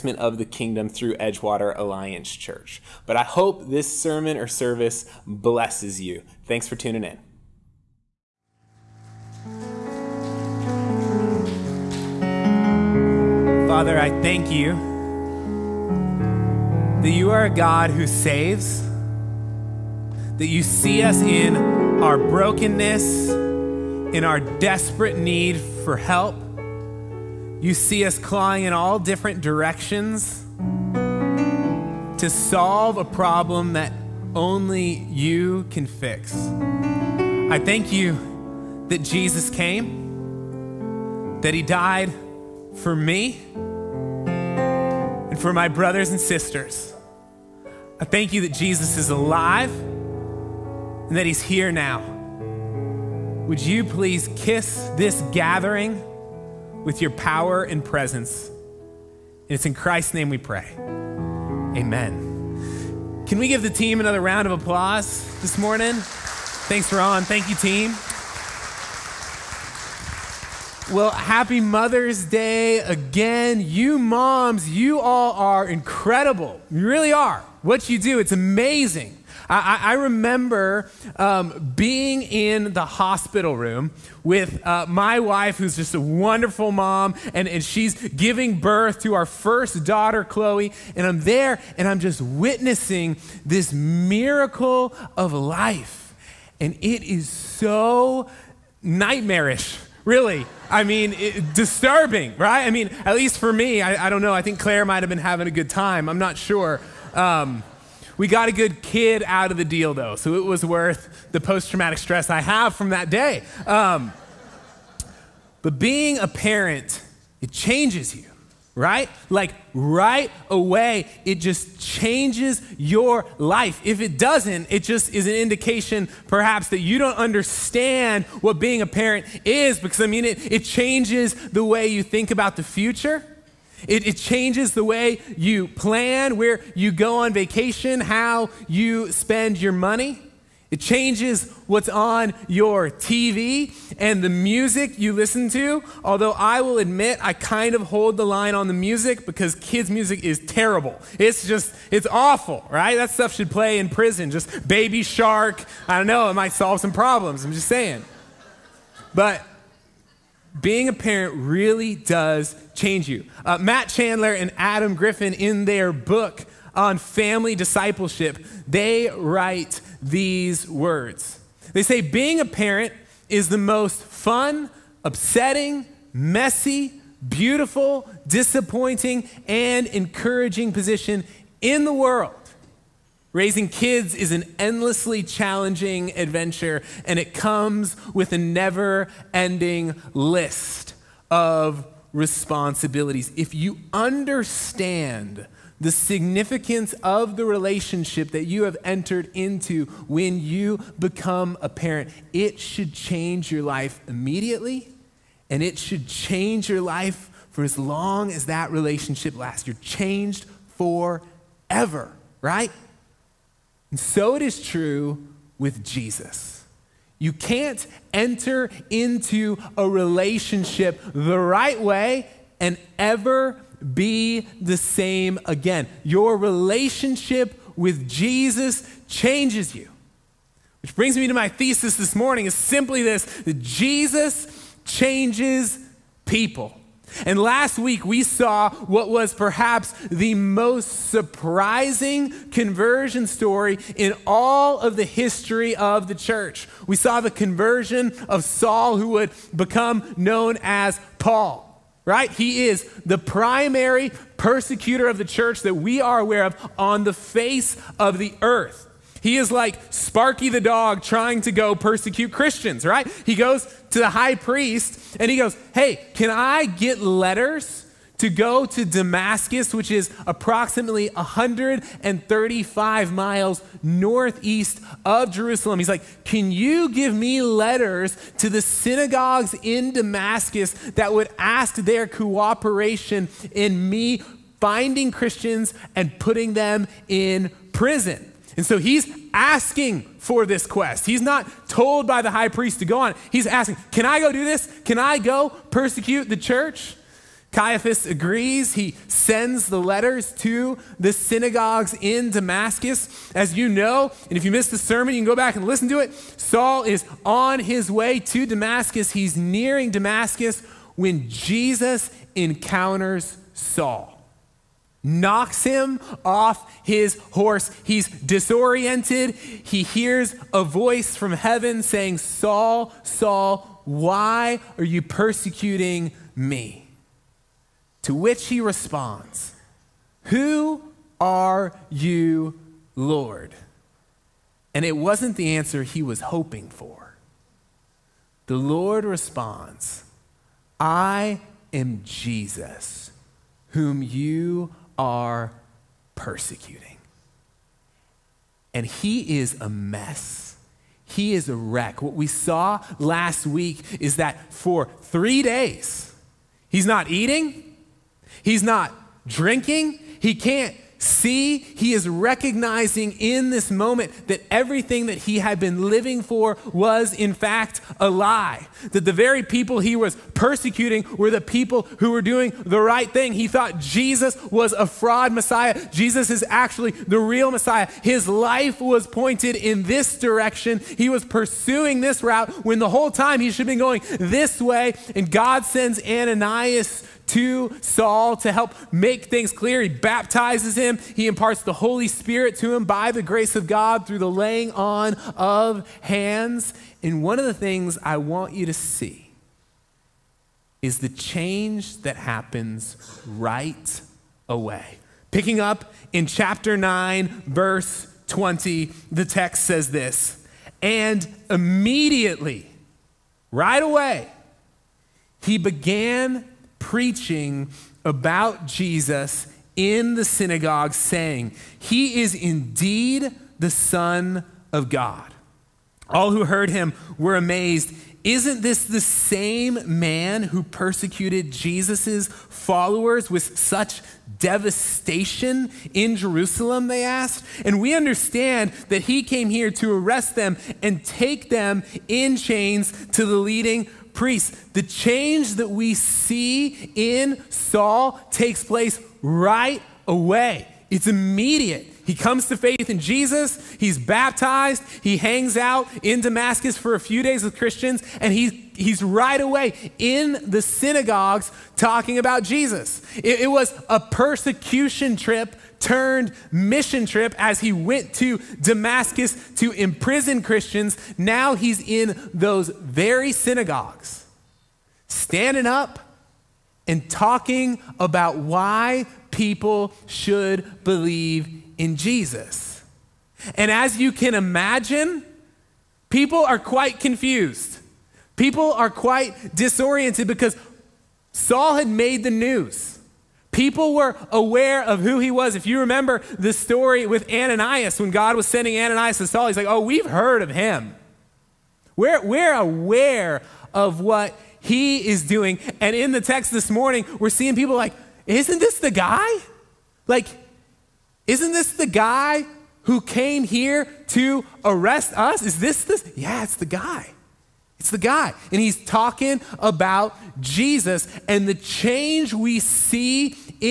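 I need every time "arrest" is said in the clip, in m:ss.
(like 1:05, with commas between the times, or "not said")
7:19, 8:34.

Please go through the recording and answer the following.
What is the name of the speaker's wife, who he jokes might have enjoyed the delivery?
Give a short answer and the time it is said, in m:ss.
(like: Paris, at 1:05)
Claire, at 1:44.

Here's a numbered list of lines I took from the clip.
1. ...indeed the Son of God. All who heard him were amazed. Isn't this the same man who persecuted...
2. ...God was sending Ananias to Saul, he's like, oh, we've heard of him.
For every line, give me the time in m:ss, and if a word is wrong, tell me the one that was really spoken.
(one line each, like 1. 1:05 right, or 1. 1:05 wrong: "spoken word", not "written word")
1. 7:02 right
2. 8:18 right.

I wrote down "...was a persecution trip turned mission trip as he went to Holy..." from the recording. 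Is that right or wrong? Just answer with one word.
wrong.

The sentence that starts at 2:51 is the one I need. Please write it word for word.
They say, Being a parent is the most fun, upsetting, messy, beautiful, disappointing, and encouraging position in the world.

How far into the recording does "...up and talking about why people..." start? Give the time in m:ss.
7:55.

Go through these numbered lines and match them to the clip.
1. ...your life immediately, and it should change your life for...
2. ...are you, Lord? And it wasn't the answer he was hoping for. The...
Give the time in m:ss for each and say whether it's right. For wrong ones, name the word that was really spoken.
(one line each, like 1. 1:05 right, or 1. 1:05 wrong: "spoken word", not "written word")
1. 3:23 right
2. 5:31 right.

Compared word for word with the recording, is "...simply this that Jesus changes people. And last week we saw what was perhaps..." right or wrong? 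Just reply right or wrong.
right.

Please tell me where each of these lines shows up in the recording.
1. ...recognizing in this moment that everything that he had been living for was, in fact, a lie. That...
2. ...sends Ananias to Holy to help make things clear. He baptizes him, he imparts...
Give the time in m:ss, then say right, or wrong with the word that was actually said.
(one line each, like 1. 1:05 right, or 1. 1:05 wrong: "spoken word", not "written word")
1. 6:02 right
2. 6:25 wrong: "Saul", not "Holy".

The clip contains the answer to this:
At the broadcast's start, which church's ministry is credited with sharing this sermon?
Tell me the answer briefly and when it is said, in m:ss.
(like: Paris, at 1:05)
Edgewater Alliance Church, at 0:01.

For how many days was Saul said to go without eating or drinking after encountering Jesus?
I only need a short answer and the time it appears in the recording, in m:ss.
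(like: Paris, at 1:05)
3, at 5:55.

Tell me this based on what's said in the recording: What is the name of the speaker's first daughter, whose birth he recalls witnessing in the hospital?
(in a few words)
Chloe.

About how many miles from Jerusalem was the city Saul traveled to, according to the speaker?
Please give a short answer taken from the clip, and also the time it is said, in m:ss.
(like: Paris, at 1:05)
135, at 4:31.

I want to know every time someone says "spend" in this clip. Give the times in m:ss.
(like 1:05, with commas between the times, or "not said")
2:19.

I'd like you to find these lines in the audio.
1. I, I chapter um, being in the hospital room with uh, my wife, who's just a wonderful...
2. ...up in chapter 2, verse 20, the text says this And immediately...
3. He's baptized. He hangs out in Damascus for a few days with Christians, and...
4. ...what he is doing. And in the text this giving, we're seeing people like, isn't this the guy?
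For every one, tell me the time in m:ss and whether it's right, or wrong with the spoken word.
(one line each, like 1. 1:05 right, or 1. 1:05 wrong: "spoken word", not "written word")
1. 1:19 wrong: "remember", not "chapter"
2. 6:45 wrong: "9", not "2"
3. 7:33 right
4. 8:23 wrong: "morning", not "giving".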